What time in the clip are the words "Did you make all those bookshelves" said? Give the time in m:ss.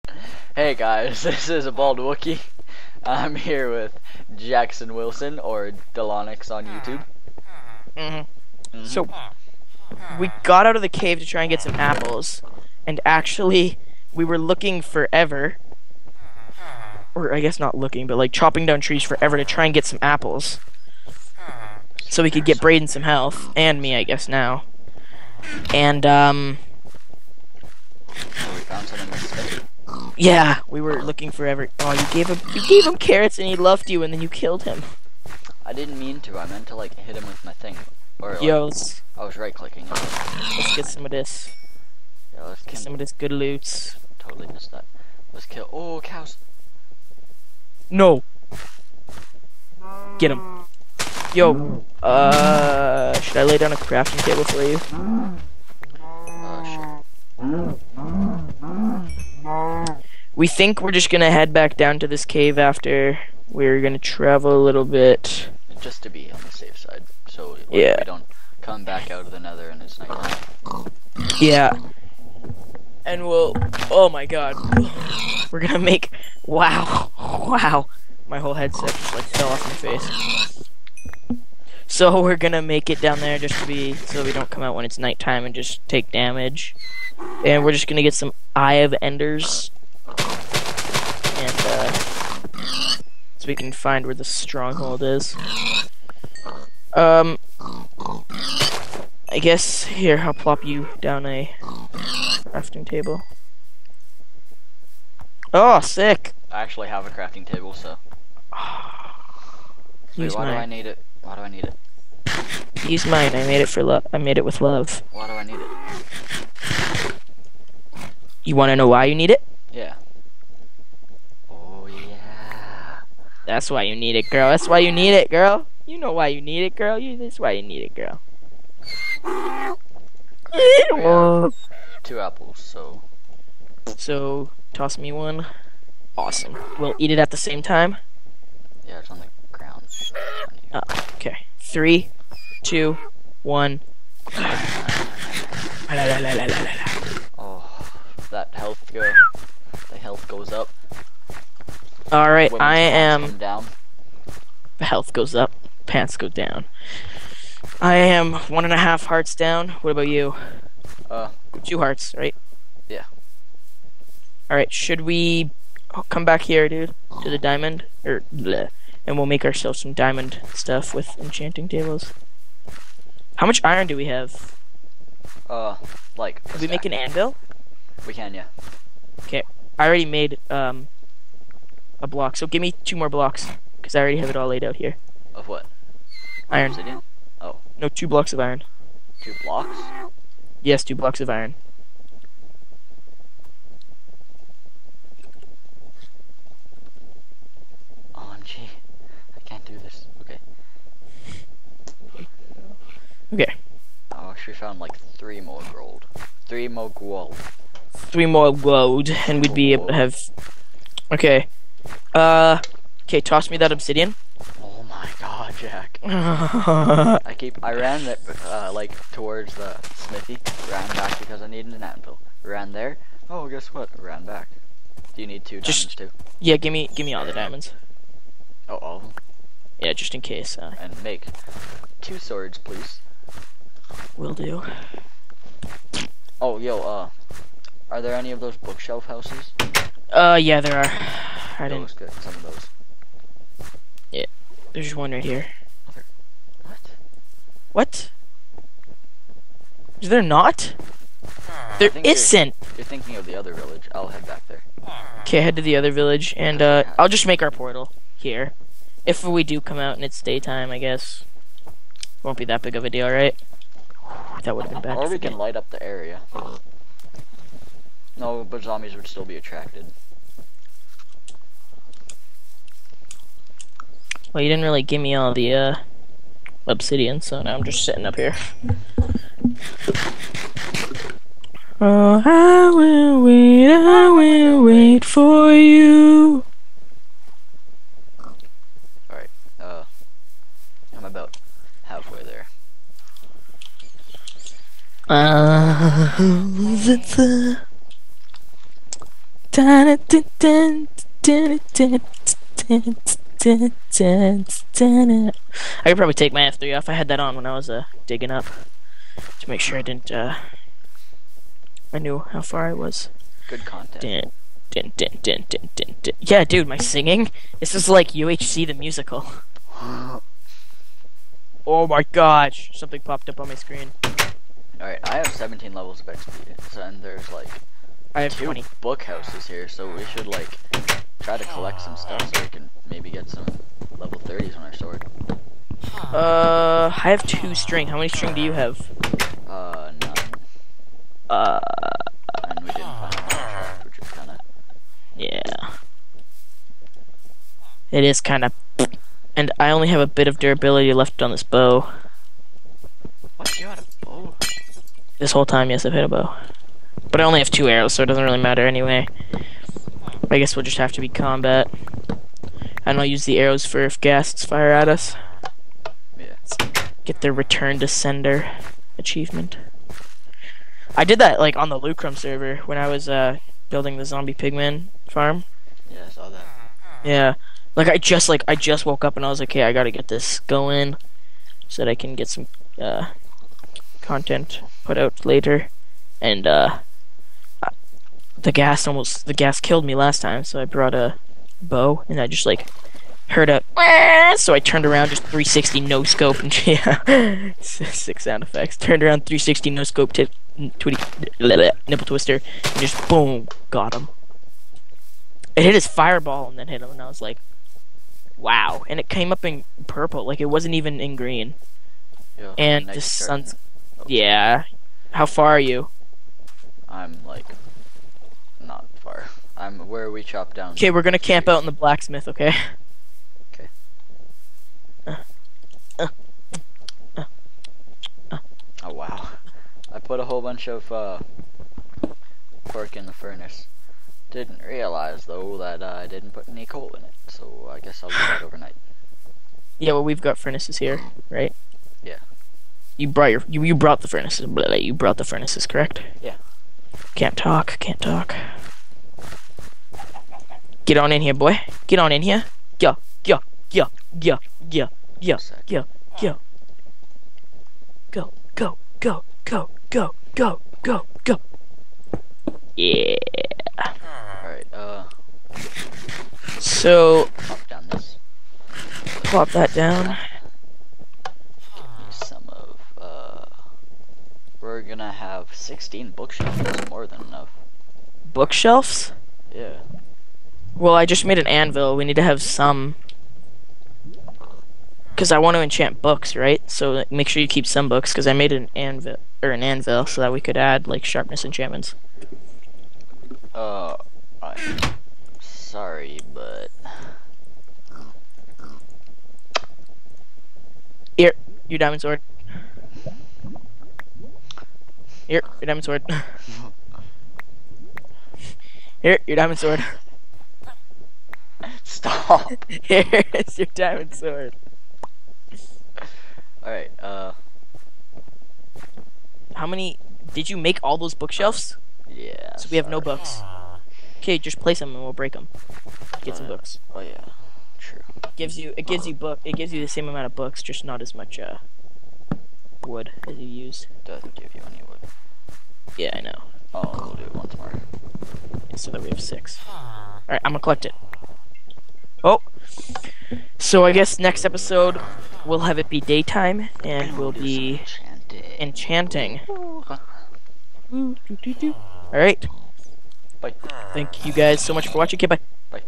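8:40.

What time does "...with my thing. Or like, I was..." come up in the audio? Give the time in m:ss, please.
0:37.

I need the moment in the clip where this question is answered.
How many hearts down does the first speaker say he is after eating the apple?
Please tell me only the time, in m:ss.
2:38.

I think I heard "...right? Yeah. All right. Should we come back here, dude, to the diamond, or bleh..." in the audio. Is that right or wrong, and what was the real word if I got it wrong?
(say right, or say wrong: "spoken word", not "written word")
right.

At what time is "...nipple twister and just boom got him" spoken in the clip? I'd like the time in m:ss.
6:41.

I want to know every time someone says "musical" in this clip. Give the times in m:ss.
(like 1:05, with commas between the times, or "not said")
5:18.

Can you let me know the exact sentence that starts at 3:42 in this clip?
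Ran there, oh, guess what, ran back.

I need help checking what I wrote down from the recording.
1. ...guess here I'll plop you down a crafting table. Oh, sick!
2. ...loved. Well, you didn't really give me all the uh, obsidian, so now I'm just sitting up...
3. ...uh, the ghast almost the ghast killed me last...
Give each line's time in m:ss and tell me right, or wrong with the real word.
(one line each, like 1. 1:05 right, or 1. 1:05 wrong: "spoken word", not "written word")
1. 1:39 right
2. 4:29 wrong: "attracted", not "loved"
3. 6:26 right.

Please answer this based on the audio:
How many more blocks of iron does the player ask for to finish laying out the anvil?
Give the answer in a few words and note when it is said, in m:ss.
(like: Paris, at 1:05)
2, at 3:02.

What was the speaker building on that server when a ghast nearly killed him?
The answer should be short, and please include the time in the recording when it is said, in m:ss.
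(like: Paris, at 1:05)
zombie pigman farm, at 6:14.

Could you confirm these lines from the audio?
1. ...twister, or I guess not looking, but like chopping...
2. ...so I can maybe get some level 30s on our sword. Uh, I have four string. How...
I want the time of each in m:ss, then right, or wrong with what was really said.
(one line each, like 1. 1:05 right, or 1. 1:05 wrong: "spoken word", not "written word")
1. 0:14 wrong: "forever", not "twister"
2. 5:32 wrong: "two", not "four".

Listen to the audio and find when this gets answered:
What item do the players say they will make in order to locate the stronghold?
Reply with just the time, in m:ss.
1:28.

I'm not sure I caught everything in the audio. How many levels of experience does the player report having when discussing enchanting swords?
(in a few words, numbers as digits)
17.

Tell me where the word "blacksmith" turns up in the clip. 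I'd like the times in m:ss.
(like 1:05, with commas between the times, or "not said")
7:01.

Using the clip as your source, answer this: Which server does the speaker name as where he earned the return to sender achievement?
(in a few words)
Lucrum.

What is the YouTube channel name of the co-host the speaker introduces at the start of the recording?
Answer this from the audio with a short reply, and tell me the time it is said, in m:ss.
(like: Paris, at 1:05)
Delonix, at 0:05.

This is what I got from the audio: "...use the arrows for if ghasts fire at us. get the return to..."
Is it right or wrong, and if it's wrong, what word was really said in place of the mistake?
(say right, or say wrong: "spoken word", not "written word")
right.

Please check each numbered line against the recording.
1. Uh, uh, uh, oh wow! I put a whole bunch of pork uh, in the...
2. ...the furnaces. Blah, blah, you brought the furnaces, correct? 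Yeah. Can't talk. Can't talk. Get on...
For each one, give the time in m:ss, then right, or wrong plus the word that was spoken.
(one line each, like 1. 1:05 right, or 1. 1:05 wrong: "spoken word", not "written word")
1. 7:05 right
2. 7:24 right.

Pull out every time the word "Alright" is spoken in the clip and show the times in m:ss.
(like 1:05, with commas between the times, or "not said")
4:49, 5:24, 7:44, 8:36.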